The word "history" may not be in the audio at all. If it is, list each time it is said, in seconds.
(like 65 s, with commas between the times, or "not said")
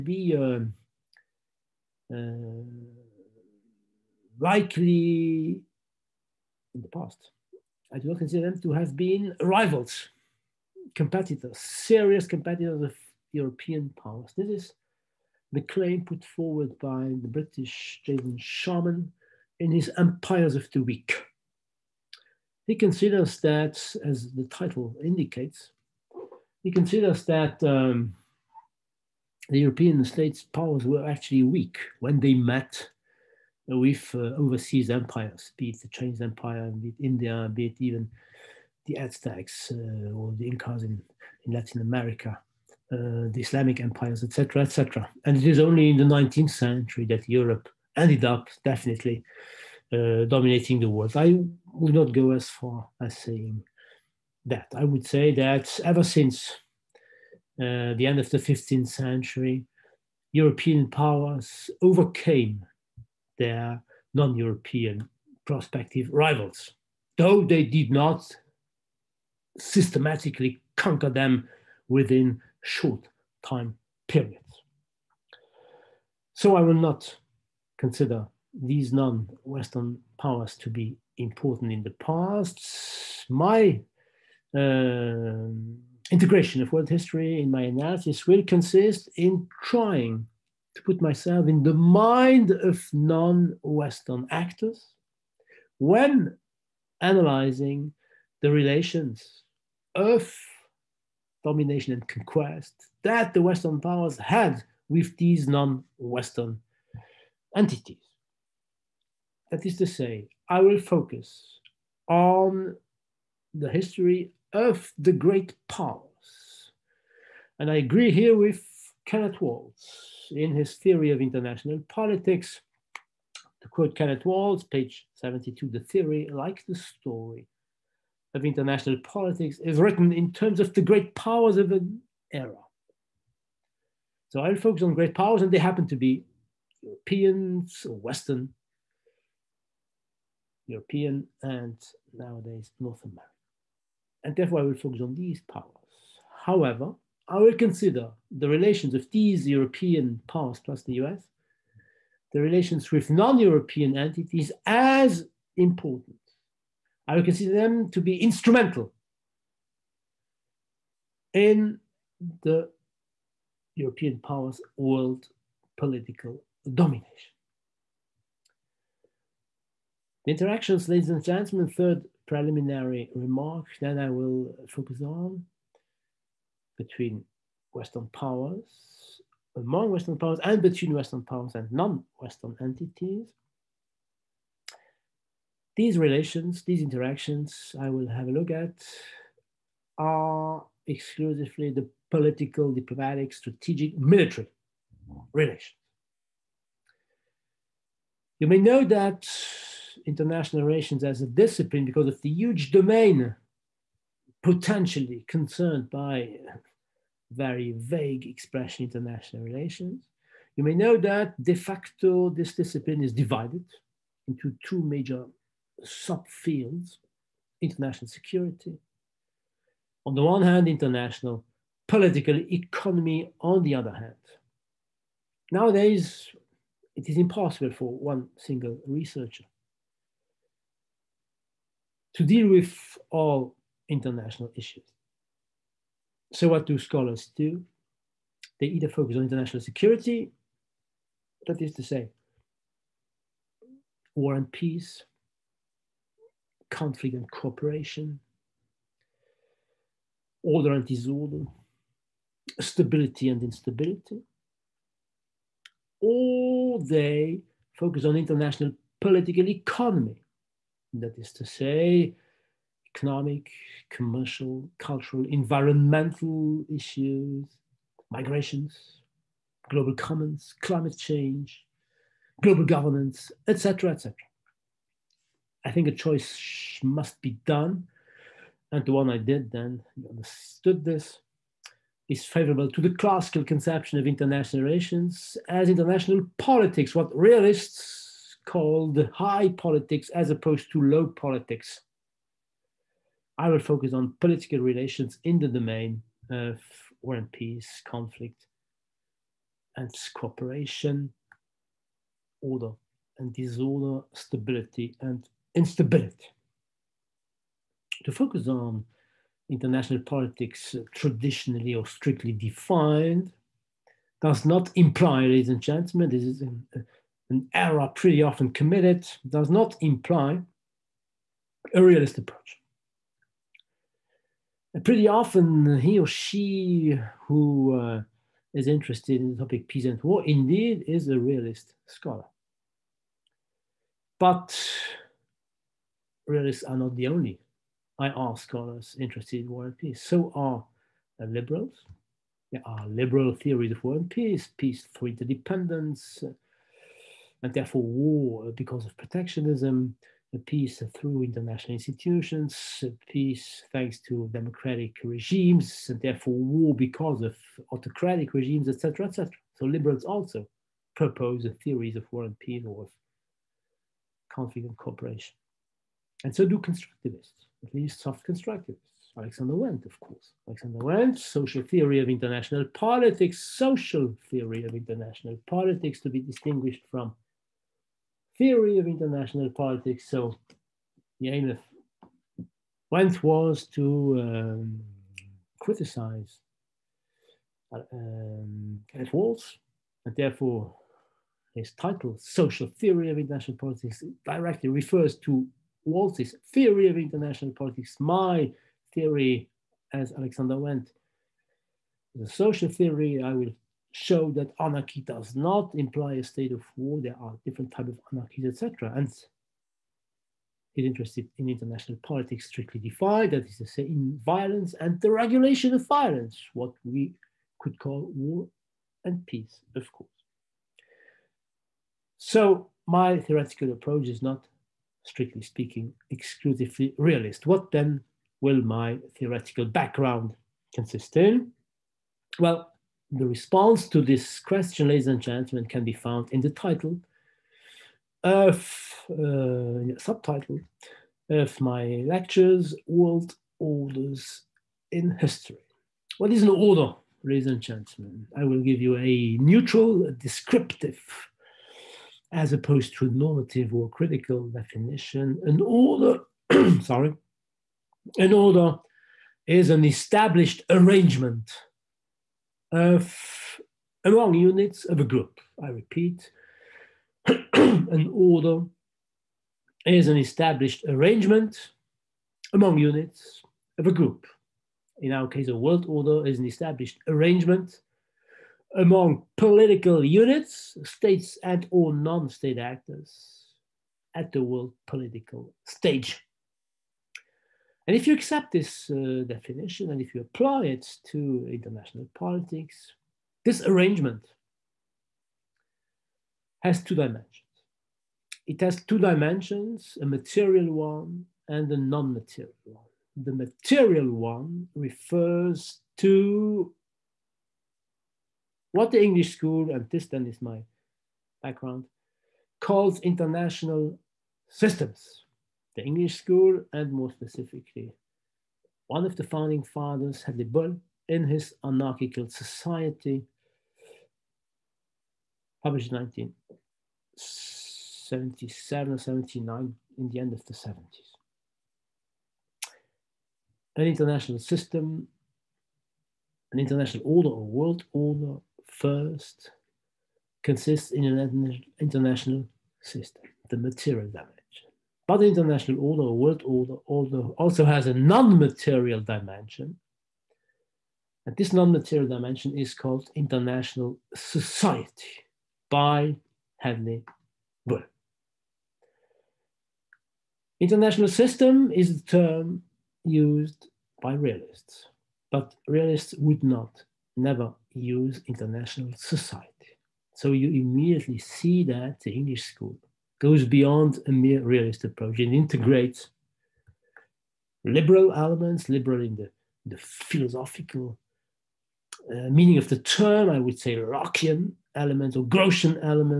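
86 s, 113 s, 445 s.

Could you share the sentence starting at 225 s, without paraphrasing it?
Nowadays, it is impossible for one single researcher to deal with all international issues.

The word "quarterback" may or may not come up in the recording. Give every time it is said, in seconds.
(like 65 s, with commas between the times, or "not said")
not said.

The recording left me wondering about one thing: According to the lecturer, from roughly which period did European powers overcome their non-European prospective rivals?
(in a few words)
end of the 15th century.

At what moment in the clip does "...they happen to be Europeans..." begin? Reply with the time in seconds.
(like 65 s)
135 s.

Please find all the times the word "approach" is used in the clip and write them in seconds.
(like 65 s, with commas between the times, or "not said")
322 s, 423 s, 574 s.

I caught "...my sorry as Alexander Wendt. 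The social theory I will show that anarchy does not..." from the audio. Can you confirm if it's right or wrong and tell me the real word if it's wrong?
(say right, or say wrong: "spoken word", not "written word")
wrong: "theory", not "sorry".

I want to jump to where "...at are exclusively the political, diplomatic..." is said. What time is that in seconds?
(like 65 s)
188 s.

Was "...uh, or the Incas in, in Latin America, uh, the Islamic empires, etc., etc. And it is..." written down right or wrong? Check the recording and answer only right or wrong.
right.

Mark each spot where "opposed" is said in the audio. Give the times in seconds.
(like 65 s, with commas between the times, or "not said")
290 s, 452 s.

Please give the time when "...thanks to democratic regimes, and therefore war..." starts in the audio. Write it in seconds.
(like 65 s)
353 s.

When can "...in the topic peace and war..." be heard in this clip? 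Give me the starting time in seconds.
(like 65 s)
329 s.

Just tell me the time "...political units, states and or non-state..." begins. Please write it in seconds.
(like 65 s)
479 s.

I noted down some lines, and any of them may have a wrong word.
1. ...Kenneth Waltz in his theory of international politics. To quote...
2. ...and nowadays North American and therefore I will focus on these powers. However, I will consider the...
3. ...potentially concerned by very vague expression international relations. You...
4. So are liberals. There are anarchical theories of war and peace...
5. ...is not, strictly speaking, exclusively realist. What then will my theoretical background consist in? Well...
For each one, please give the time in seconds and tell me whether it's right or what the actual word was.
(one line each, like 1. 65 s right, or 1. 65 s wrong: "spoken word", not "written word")
1. 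119 s right
2. 141 s right
3. 204 s right
4. 340 s wrong: "liberal", not "anarchical"
5. 424 s right.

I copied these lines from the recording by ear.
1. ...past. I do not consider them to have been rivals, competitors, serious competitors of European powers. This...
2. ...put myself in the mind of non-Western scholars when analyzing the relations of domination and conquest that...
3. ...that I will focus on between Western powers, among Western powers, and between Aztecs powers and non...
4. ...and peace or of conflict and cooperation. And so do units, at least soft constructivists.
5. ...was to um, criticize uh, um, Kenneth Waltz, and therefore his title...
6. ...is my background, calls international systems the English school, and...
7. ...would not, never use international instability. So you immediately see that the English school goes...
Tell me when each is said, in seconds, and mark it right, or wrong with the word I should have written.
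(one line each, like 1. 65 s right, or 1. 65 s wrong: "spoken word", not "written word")
1. 6 s right
2. 90 s wrong: "actors", not "scholars"
3. 173 s wrong: "Western", not "Aztecs"
4. 362 s wrong: "constructivists", not "units"
5. 383 s right
6. 510 s right
7. 566 s wrong: "society", not "instability".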